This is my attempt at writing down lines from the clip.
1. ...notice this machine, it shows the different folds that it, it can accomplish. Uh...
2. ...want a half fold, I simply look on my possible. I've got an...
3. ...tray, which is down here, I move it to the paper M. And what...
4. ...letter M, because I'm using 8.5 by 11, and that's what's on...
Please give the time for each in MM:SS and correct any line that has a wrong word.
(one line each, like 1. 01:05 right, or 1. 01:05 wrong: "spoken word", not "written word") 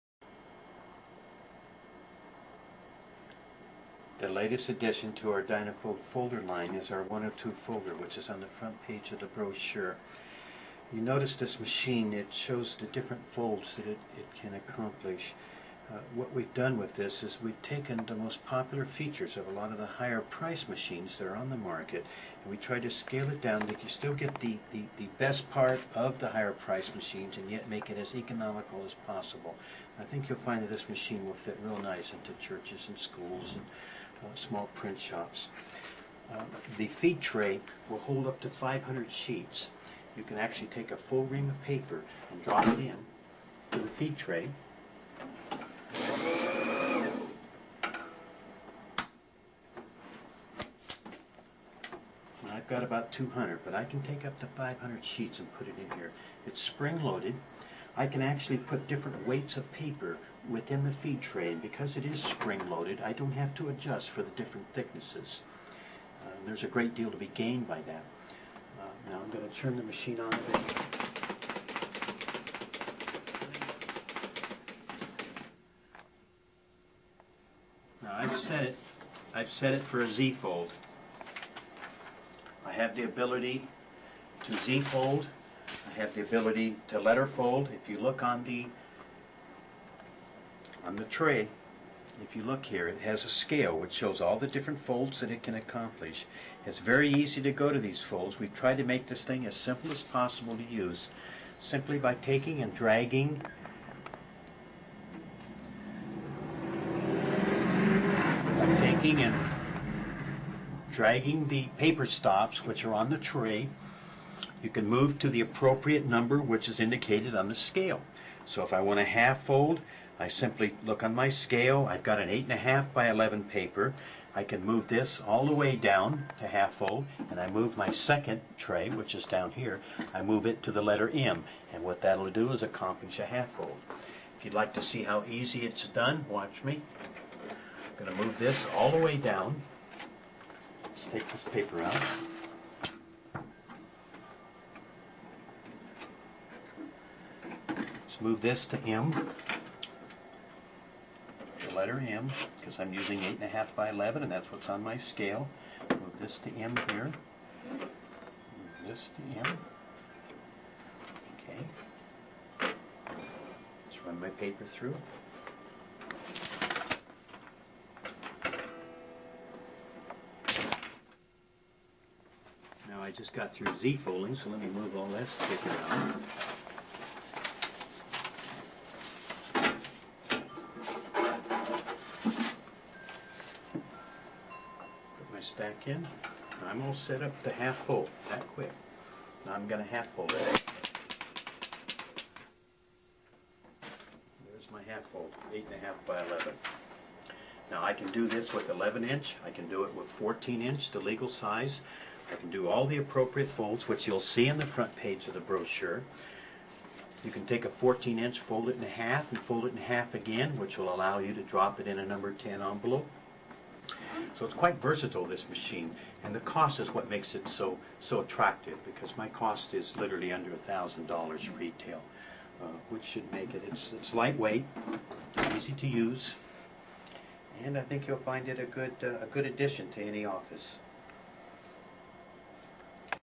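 1. 00:11 right
2. 01:58 wrong: "scale", not "possible"
3. 02:08 wrong: "letter", not "paper"
4. 02:31 right.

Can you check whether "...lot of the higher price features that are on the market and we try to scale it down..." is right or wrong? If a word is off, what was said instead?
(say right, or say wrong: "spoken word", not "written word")
wrong: "machines", not "features".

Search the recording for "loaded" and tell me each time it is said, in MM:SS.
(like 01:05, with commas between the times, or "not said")
00:56, 01:02.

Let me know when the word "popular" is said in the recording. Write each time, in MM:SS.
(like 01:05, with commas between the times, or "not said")
00:18.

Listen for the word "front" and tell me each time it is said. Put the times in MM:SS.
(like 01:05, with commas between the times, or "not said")
00:08, 03:24.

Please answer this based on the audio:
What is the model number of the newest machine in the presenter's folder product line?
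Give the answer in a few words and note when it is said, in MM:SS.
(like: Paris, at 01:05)
102, at 00:07.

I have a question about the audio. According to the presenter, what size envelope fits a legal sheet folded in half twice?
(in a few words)
number 10.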